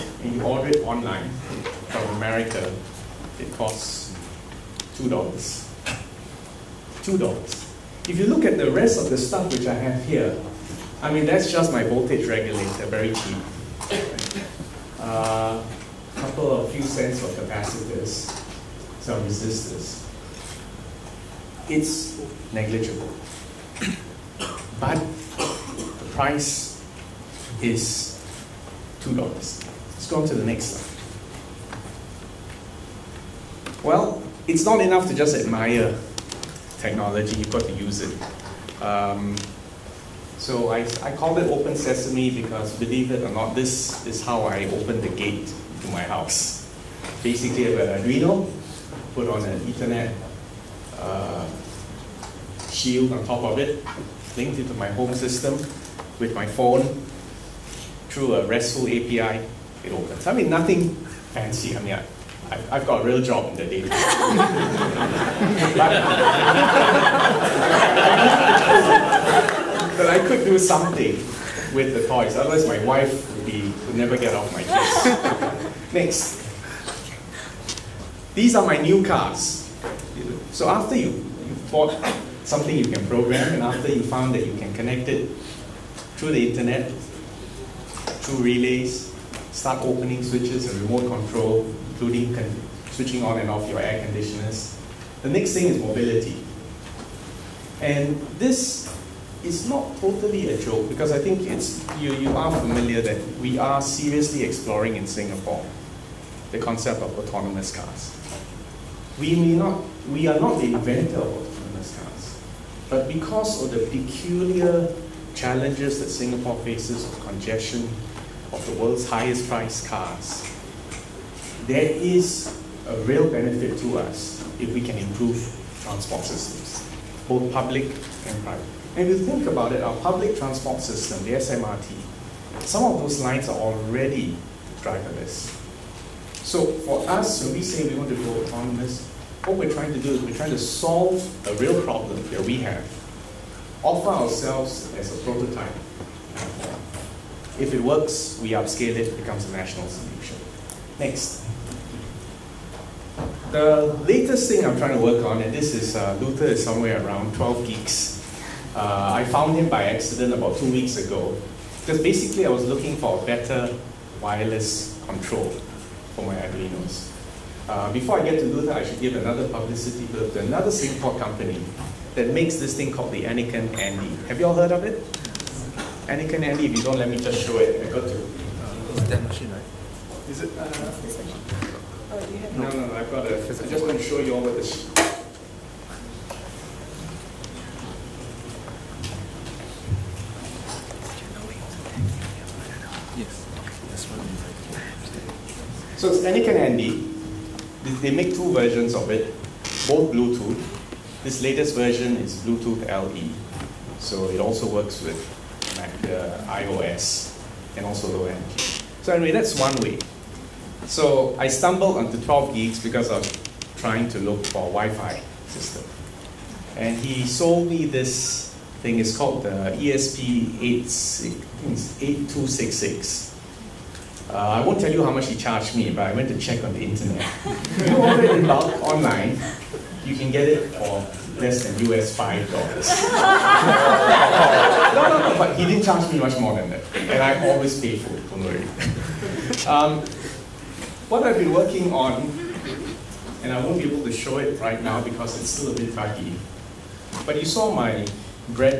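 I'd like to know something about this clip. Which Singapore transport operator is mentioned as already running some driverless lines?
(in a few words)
SMRT.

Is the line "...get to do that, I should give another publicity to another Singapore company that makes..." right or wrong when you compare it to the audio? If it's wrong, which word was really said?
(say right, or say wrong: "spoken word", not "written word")
right.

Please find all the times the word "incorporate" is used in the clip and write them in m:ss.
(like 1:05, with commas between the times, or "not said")
not said.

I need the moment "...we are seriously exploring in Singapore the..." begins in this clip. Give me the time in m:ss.
1:43.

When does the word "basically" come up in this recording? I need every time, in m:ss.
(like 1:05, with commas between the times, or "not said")
0:47, 2:42.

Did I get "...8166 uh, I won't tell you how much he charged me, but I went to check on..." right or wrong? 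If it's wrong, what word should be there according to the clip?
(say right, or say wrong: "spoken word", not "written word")
wrong: "8266", not "8166".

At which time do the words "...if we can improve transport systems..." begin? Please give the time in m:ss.
2:04.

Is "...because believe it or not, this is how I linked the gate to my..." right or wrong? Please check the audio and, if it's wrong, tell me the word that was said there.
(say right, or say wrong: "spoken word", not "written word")
wrong: "opened", not "linked".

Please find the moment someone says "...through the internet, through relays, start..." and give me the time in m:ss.
1:26.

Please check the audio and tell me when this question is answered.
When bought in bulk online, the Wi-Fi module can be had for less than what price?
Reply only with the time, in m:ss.
3:51.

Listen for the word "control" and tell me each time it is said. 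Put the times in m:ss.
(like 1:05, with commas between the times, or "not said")
1:31, 2:45.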